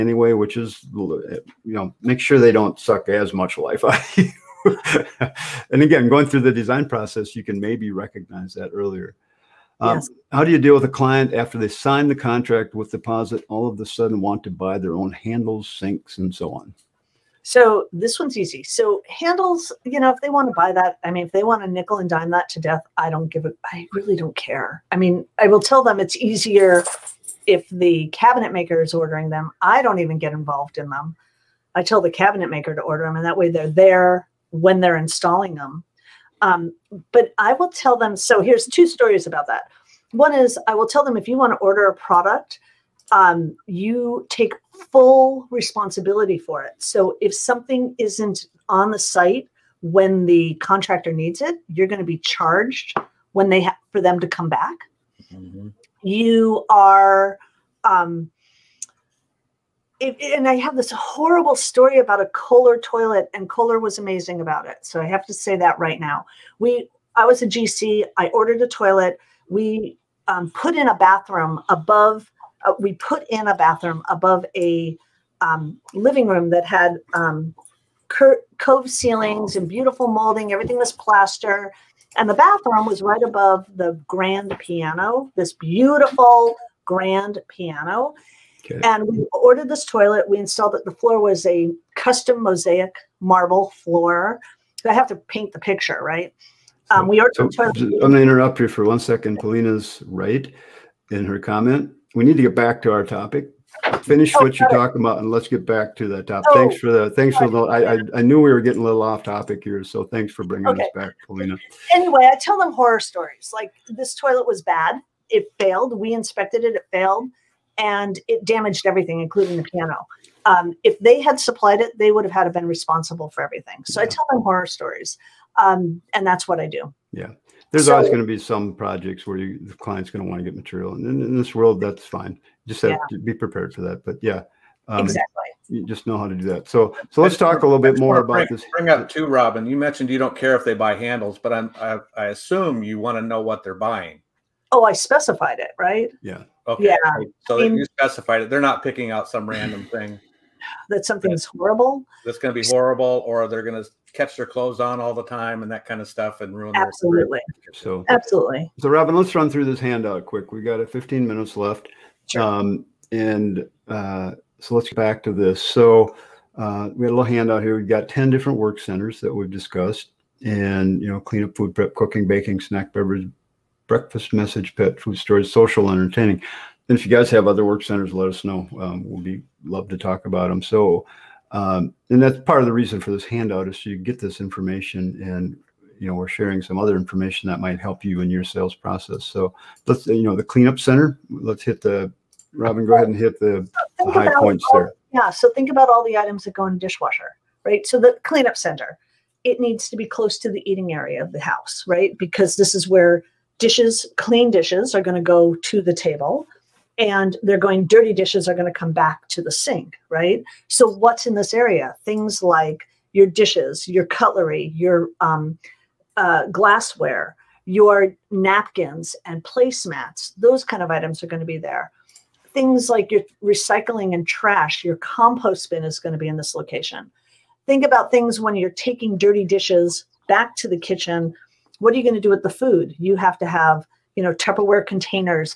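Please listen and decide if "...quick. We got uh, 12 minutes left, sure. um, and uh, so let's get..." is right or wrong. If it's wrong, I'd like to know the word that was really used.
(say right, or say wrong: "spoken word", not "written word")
wrong: "15", not "12".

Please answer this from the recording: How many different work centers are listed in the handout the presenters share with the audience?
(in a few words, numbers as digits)
10.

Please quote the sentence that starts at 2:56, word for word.
And if you guys have other work centers, let us know.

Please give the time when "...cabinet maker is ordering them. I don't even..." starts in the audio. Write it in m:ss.
0:28.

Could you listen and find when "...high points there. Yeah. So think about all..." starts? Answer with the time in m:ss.
3:14.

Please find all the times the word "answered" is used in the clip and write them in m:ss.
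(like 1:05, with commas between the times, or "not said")
not said.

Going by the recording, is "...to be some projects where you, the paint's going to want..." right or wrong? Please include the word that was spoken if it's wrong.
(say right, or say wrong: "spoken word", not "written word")
wrong: "client", not "paint".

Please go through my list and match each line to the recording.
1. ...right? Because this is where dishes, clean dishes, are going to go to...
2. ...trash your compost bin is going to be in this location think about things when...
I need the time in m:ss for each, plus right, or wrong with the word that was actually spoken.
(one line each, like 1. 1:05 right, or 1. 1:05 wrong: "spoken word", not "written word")
1. 3:21 right
2. 3:44 right.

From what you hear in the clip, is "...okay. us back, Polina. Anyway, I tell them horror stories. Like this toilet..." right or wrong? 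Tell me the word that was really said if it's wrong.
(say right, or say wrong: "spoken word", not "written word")
right.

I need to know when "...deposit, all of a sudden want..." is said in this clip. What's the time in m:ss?
0:12.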